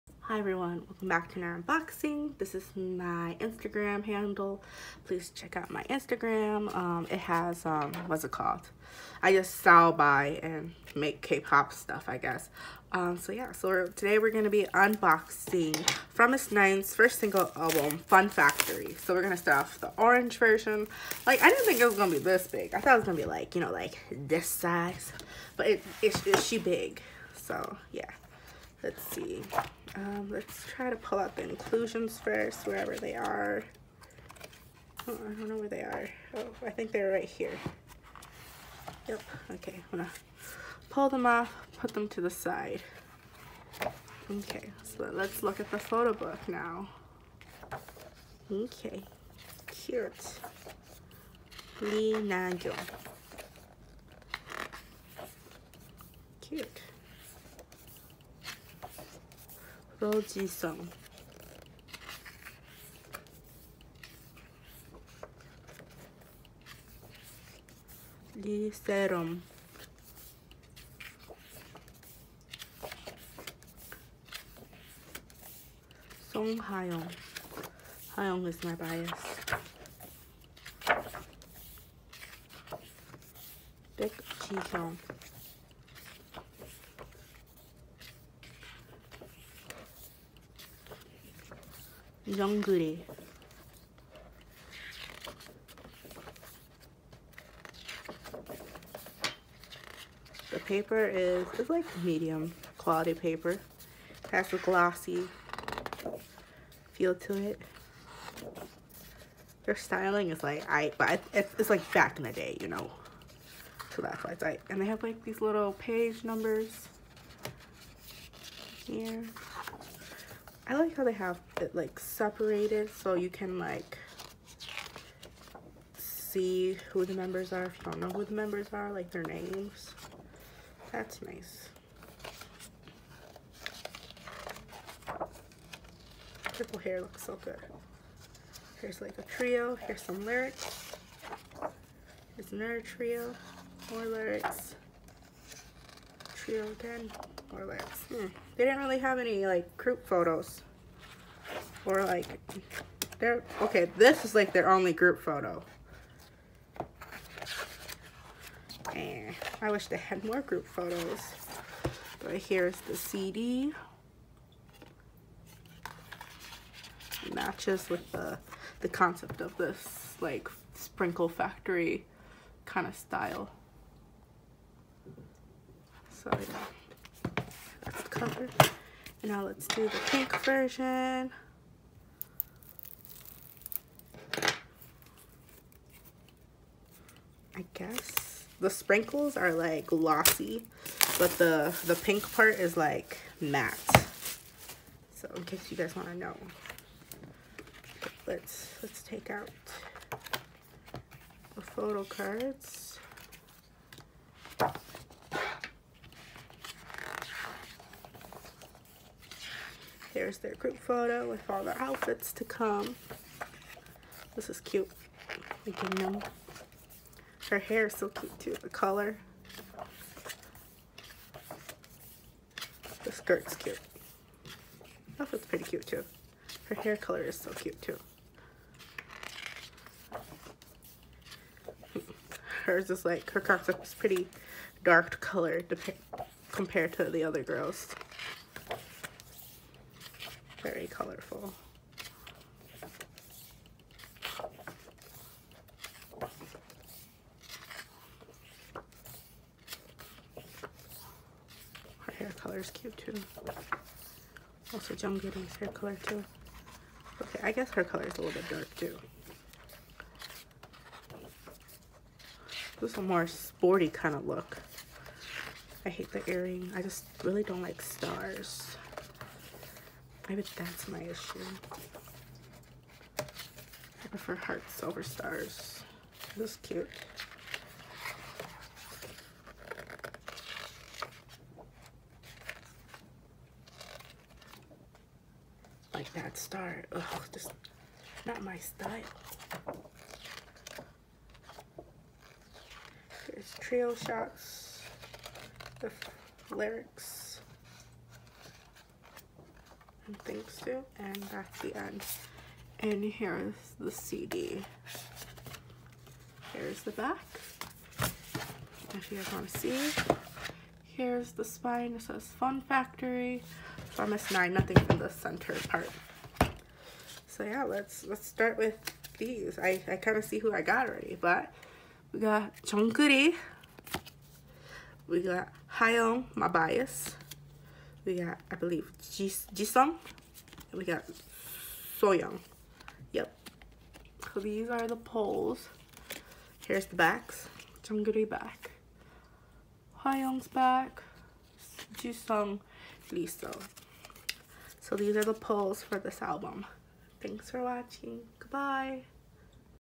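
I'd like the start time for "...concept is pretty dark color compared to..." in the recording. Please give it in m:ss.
3:53.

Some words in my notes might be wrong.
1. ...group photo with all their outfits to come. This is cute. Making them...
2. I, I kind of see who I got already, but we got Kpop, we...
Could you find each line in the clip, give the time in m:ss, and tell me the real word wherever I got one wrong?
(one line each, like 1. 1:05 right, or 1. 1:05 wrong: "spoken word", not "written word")
1. 3:30 right
2. 5:19 wrong: "Jungkook", not "Kpop".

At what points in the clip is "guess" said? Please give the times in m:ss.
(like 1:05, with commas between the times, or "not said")
0:12, 3:07, 4:17.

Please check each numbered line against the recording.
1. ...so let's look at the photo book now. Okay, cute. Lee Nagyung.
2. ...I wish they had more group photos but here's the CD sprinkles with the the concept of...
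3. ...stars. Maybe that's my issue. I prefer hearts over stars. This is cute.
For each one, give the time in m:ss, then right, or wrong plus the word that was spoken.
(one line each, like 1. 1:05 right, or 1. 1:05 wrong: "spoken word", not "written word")
1. 0:44 right
2. 2:39 wrong: "matches", not "sprinkles"
3. 4:27 right.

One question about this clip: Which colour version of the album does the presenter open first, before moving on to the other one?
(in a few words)
Orange.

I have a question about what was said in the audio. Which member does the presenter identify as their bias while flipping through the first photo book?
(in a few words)
Song Hayoung.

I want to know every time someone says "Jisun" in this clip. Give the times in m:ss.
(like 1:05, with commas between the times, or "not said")
5:29, 5:41.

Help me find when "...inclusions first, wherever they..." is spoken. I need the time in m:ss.
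0:31.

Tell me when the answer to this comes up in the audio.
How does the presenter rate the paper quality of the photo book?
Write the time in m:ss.
1:42.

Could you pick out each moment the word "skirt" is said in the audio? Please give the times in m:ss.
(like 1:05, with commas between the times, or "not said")
3:43.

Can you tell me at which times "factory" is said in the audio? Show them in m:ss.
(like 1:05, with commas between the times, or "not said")
0:18, 2:51, 5:12.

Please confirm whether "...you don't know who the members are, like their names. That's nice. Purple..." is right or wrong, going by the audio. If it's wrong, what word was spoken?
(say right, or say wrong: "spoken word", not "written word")
right.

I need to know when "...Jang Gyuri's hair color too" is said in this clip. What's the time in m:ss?
4:14.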